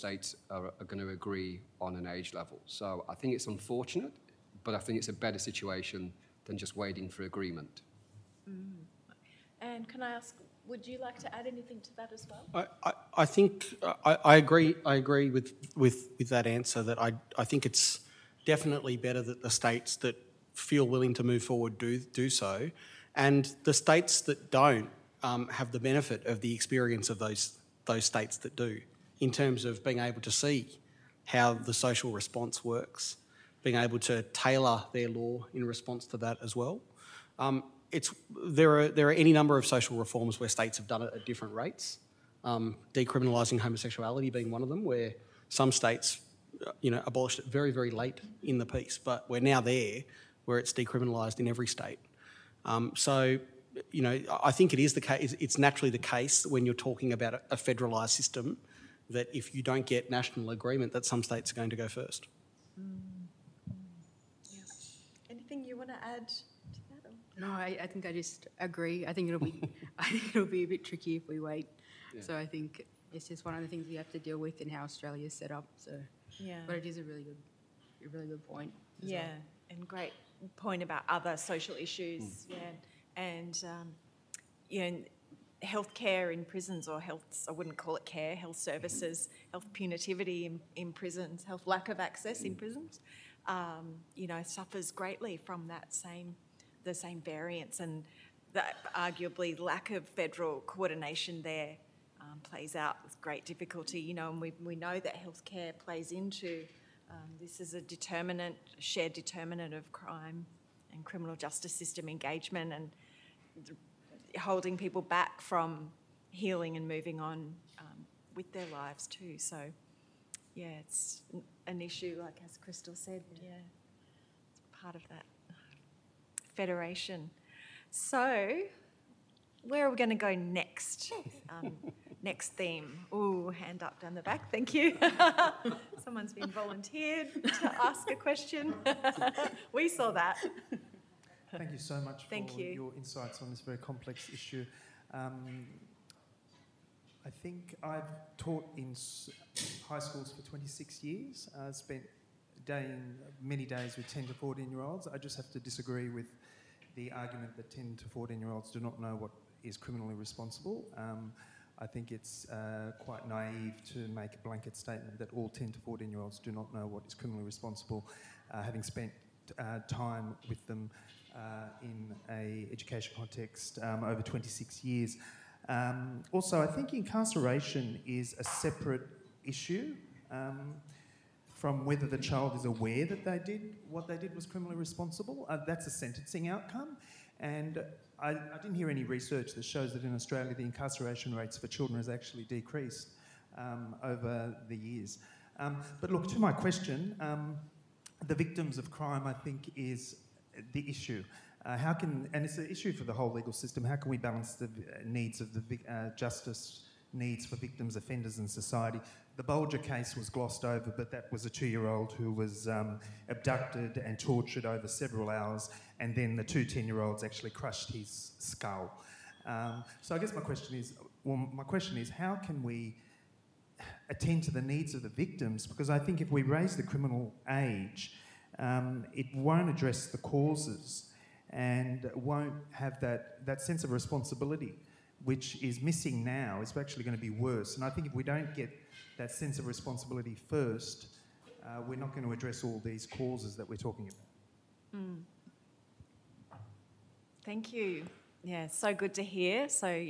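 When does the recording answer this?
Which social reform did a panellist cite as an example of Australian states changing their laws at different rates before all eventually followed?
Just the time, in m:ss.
0:42.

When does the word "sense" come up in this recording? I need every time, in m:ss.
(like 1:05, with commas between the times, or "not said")
3:53, 3:59.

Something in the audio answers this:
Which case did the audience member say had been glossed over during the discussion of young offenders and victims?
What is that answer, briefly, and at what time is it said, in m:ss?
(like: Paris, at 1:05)
The Bulger case, at 3:29.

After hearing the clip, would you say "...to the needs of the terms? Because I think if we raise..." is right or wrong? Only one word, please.
wrong.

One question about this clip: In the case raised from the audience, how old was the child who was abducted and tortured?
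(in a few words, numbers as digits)
2.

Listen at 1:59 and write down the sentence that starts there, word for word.
So, yeah, it's an issue, like as Crystal said, yeah, yeah it's part of that federation.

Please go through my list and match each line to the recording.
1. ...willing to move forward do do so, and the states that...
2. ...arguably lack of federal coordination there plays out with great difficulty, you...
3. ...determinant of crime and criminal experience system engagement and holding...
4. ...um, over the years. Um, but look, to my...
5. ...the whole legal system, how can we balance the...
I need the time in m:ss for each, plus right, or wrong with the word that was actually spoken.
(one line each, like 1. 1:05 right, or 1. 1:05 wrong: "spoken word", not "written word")
1. 0:20 right
2. 1:38 right
3. 1:49 wrong: "justice", not "experience"
4. 3:13 right
5. 3:23 right.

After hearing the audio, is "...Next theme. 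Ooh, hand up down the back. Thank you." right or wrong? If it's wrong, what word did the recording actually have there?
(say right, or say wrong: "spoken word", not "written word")
right.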